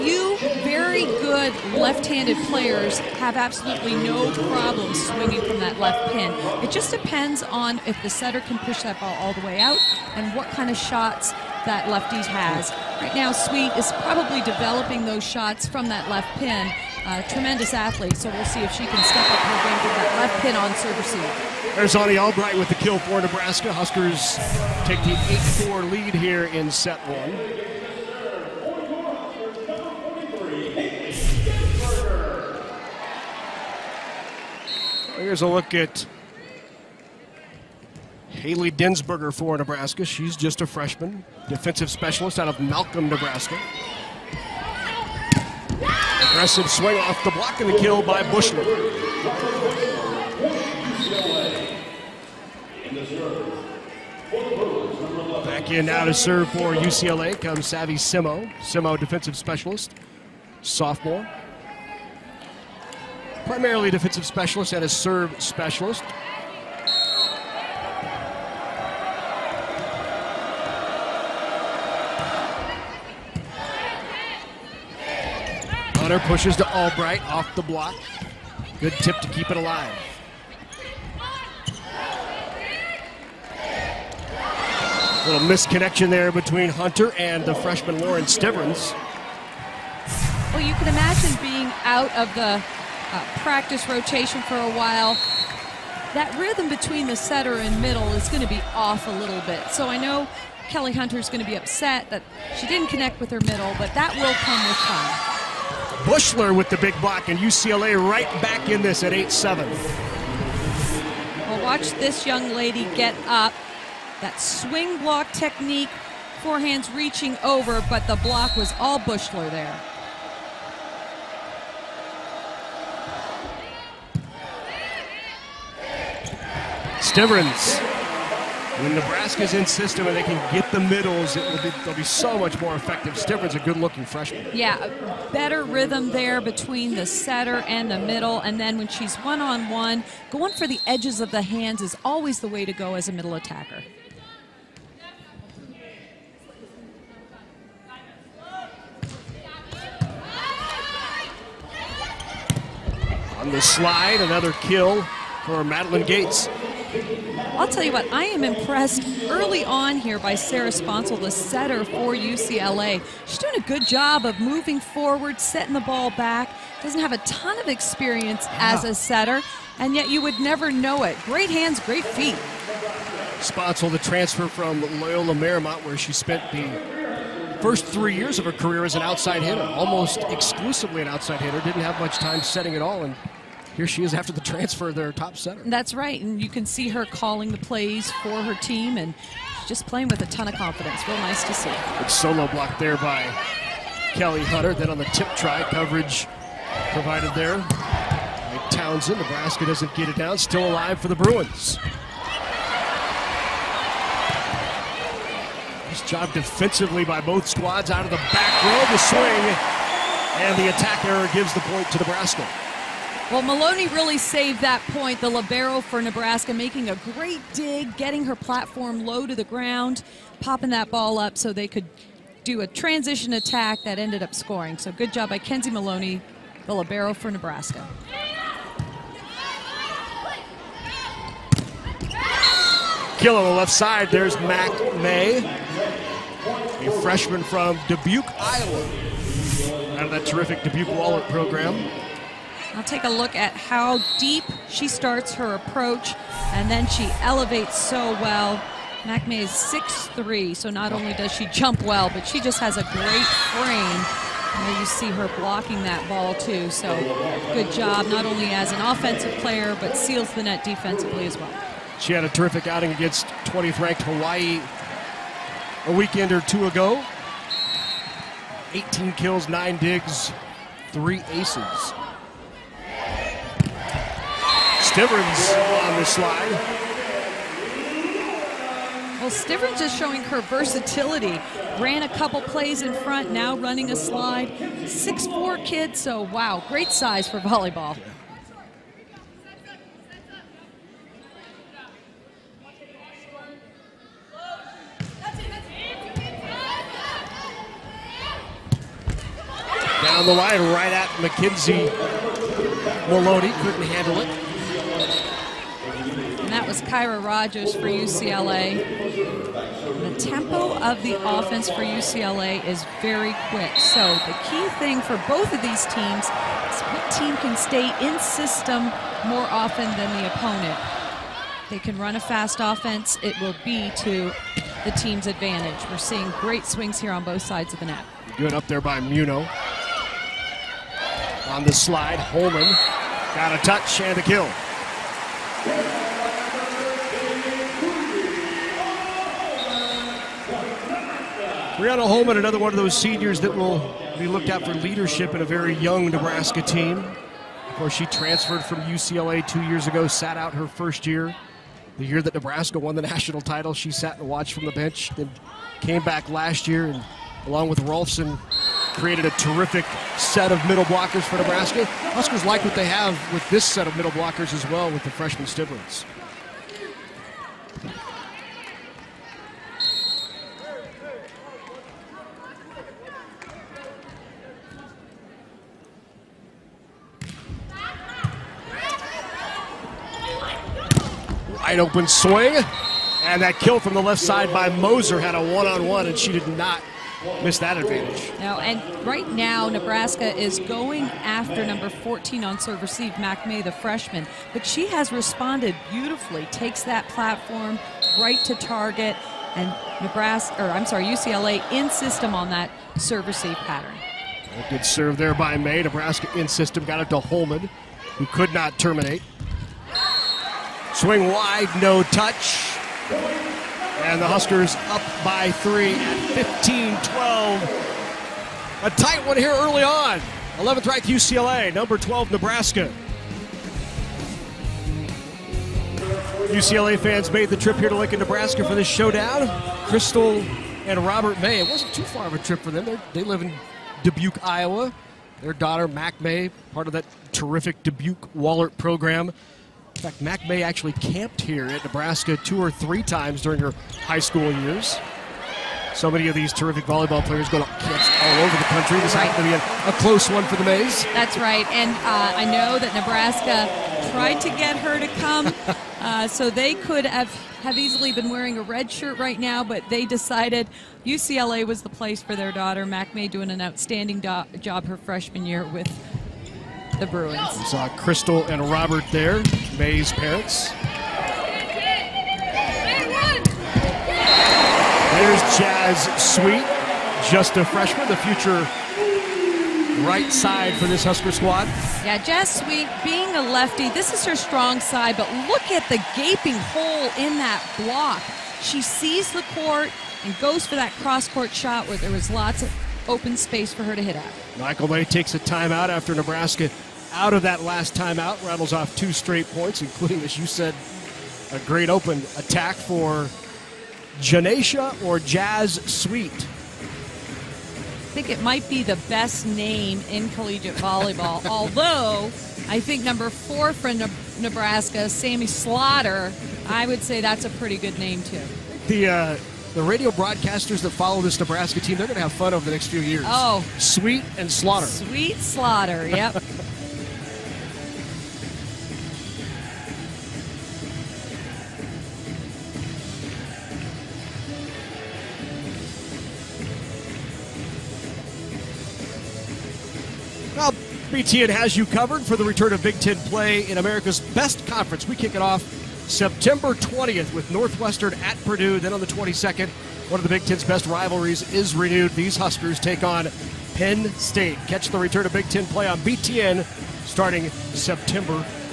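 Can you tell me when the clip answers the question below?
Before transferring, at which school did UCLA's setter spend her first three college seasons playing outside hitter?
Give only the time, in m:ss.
2:54.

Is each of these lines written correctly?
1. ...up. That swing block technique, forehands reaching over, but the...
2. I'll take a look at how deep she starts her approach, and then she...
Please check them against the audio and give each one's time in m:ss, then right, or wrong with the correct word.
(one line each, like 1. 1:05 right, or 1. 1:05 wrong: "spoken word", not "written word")
1. 1:53 right
2. 4:02 right.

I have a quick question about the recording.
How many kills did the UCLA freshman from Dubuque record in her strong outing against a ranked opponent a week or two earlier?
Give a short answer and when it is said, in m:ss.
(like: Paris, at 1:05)
18, at 4:28.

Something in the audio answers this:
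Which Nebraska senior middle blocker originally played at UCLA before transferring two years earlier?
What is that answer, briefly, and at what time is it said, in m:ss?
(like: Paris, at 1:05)
Briana Holman, at 5:41.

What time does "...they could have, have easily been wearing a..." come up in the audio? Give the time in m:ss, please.
7:36.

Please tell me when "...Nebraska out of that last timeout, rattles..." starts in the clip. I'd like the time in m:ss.
8:16.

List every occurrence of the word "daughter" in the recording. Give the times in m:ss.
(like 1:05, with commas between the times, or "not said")
7:15, 7:42.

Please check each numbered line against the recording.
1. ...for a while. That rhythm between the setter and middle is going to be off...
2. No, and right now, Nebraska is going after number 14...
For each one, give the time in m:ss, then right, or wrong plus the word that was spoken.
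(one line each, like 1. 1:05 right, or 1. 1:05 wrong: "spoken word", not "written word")
1. 1:34 right
2. 6:28 right.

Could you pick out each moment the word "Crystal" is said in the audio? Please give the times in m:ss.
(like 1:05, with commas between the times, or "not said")
7:09, 7:47.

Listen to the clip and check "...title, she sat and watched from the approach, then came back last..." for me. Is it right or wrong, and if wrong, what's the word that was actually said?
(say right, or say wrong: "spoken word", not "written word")
wrong: "bench", not "approach".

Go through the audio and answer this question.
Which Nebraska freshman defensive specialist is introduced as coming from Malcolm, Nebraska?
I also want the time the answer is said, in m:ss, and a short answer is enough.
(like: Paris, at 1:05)
Haley Densberger, at 0:38.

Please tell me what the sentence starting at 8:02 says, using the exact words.
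Yeah, Jazz Sweet being a lefty, this is her strong side, but look at the gaping hole in that block.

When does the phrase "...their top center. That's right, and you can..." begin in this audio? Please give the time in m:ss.
3:04.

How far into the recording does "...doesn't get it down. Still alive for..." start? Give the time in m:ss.
3:19.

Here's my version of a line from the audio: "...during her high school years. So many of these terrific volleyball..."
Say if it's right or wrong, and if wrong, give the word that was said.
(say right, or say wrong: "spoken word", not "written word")
right.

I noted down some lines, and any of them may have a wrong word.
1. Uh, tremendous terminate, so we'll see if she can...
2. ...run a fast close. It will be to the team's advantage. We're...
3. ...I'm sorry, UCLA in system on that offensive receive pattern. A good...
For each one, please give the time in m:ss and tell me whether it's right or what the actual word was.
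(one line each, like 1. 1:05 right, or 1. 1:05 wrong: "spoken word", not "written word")
1. 0:17 wrong: "athlete", not "terminate"
2. 5:21 wrong: "offense", not "close"
3. 6:40 wrong: "serve", not "offensive".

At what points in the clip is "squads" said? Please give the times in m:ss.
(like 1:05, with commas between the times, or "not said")
3:27, 8:01.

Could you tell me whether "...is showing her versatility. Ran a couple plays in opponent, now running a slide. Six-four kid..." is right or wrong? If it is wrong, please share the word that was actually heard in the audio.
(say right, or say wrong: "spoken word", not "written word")
wrong: "front", not "opponent".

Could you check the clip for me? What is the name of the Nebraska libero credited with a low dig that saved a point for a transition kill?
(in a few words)
Kenzie Maloney.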